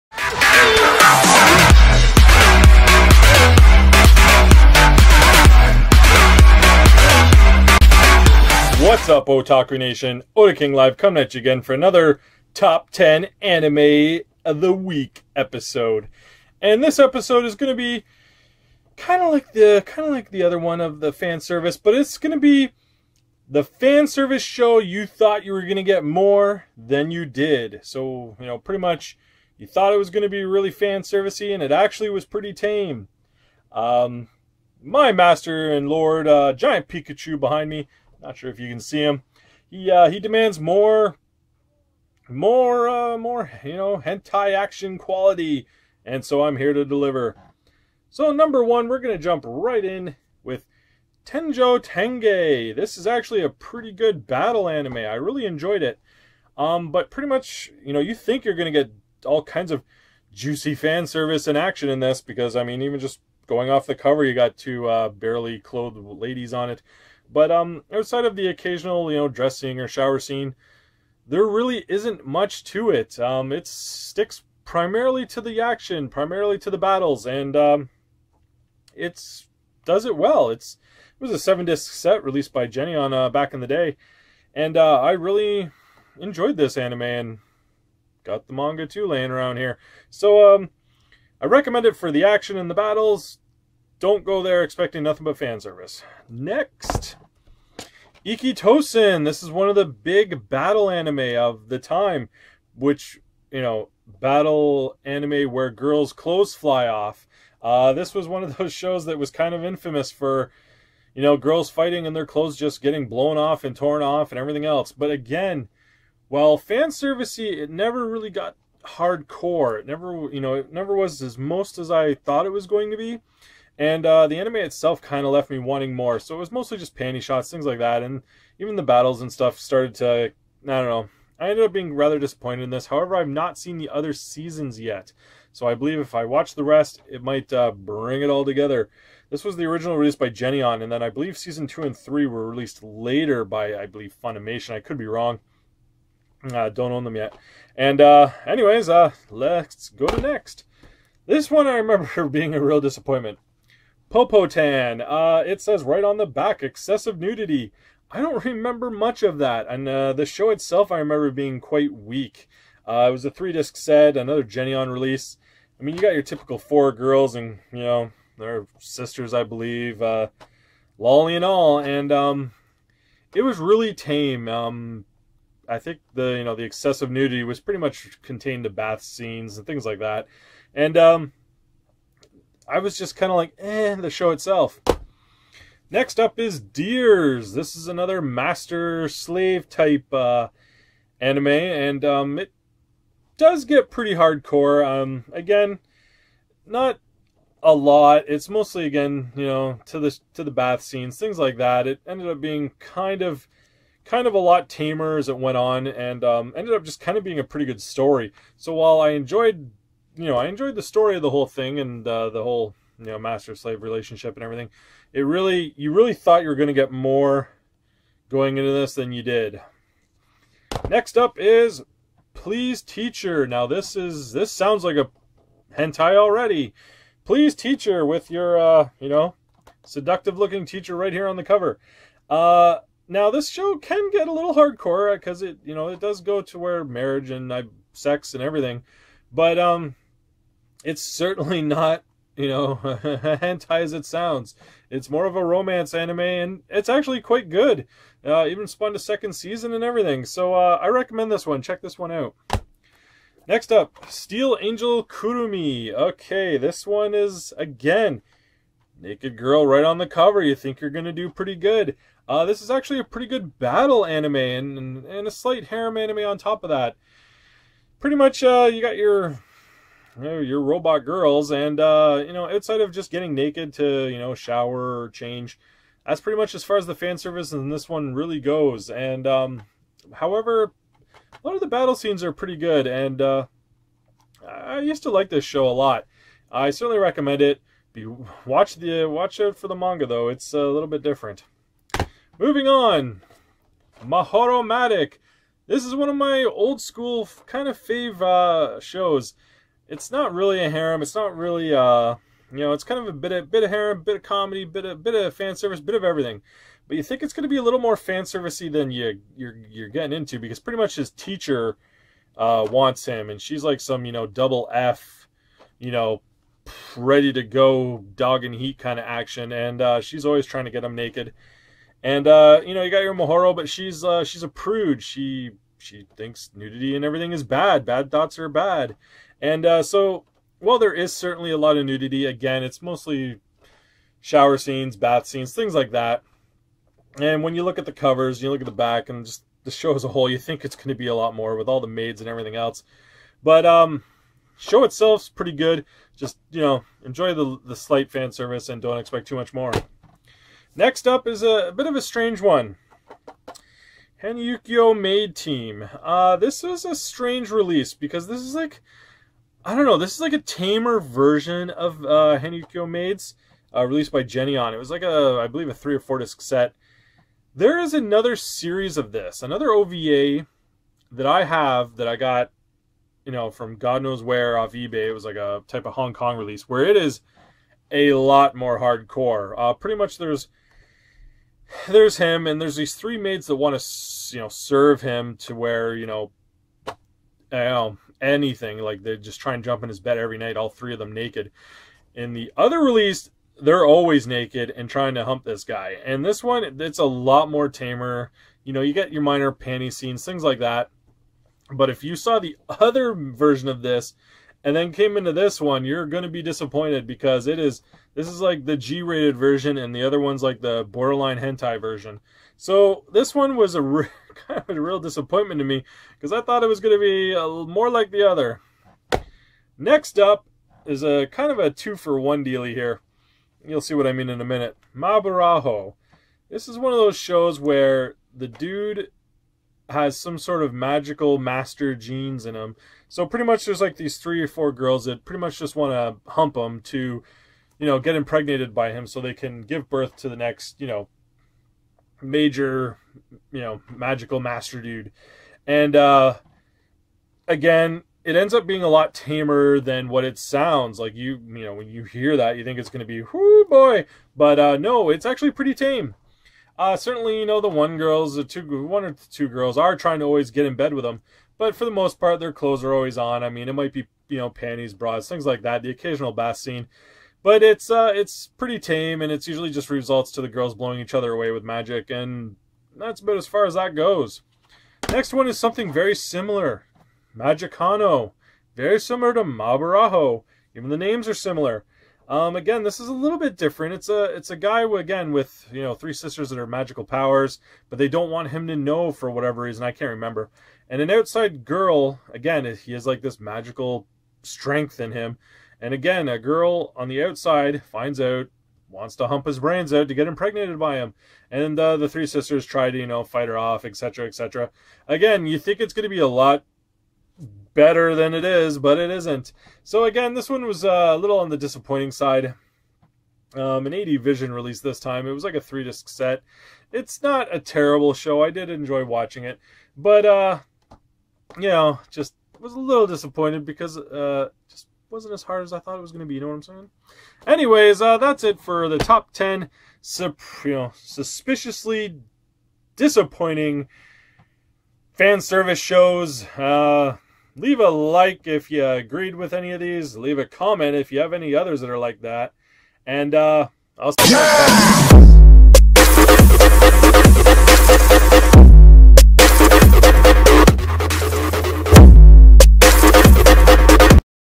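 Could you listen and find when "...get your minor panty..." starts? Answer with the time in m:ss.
6:38.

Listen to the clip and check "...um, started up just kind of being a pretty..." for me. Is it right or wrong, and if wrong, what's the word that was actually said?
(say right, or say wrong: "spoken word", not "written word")
wrong: "ended", not "started".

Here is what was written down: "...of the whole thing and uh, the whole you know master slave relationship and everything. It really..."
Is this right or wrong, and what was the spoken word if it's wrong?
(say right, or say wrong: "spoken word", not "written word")
right.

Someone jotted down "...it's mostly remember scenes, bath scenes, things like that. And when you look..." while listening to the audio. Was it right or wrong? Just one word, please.
wrong.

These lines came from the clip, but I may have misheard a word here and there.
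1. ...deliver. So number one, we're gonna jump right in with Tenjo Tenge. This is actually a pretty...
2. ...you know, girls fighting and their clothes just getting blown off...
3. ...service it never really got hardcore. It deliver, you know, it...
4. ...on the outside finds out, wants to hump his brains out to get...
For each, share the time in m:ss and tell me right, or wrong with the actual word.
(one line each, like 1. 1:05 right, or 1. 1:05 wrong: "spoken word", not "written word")
1. 0:46 right
2. 1:51 right
3. 1:56 wrong: "never", not "deliver"
4. 8:16 right.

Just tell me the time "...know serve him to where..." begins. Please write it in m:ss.
6:24.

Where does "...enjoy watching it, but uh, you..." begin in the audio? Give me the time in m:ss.
8:38.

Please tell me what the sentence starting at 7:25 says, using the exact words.
And uh, again, it ends up being a lot tamer than what it sounds like.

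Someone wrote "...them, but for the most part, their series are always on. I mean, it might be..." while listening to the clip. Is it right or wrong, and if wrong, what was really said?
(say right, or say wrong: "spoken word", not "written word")
wrong: "clothes", not "series".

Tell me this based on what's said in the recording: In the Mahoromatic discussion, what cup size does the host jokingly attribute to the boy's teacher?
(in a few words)
Double F.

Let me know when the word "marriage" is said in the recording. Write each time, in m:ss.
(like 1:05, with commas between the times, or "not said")
3:56.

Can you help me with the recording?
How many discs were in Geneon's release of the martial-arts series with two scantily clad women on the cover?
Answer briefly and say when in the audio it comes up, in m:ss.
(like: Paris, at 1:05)
7, at 1:21.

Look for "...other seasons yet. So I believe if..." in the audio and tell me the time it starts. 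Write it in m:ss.
2:13.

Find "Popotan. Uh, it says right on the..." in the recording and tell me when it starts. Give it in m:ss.
2:34.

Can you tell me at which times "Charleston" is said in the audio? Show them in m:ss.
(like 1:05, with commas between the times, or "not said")
not said.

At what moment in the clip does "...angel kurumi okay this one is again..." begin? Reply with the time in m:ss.
4:14.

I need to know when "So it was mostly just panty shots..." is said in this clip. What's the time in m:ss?
2:06.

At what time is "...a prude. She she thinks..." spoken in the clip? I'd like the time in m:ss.
5:24.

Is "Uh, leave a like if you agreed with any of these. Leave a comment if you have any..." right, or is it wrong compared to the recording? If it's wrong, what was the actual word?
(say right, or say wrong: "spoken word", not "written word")
right.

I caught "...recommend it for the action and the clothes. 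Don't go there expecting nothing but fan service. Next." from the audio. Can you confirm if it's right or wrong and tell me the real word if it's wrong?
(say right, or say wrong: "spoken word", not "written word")
wrong: "battles", not "clothes".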